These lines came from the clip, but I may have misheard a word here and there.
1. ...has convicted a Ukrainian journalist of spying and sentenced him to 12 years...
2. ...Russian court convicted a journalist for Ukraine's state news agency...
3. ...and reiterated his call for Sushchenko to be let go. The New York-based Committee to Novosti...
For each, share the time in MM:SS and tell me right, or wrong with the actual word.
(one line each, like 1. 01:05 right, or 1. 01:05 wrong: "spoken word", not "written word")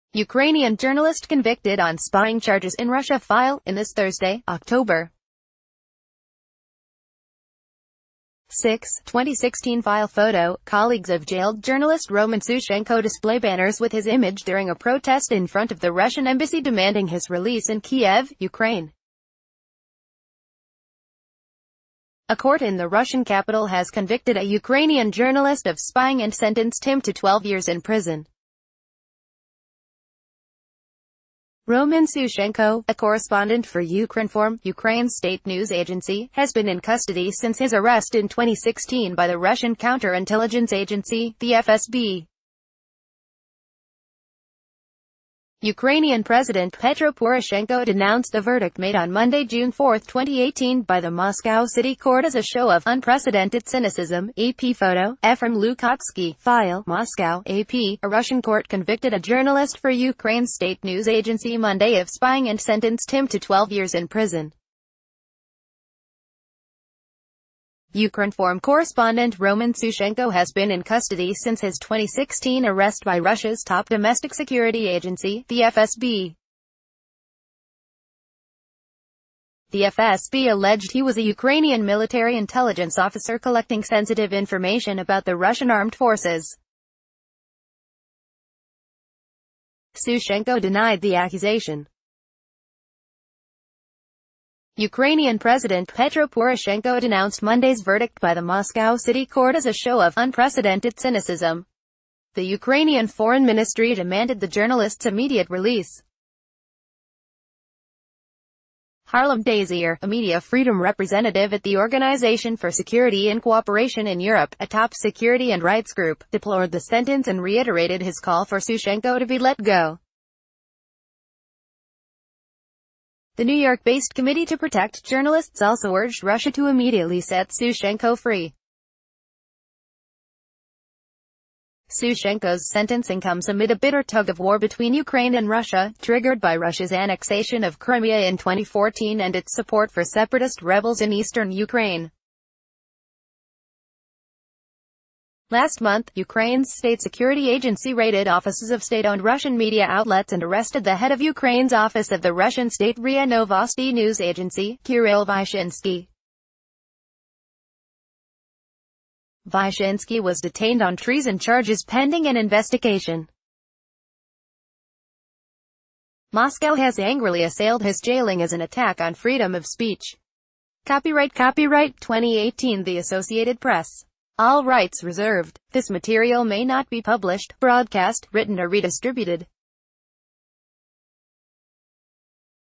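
1. 00:23 right
2. 00:58 right
3. 01:57 wrong: "Protect", not "Novosti".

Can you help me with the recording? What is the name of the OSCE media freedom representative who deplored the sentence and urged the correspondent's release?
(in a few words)
Harlem Desir.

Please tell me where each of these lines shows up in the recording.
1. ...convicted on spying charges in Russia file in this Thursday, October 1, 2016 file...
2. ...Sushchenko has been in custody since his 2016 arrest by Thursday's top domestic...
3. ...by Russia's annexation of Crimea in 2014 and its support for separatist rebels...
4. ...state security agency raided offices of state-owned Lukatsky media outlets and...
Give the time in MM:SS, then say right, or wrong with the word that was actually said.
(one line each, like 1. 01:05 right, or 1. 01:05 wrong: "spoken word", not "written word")
1. 00:01 wrong: "6", not "1"
2. 01:09 wrong: "Russia", not "Thursday"
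3. 02:16 right
4. 02:26 wrong: "Russian", not "Lukatsky".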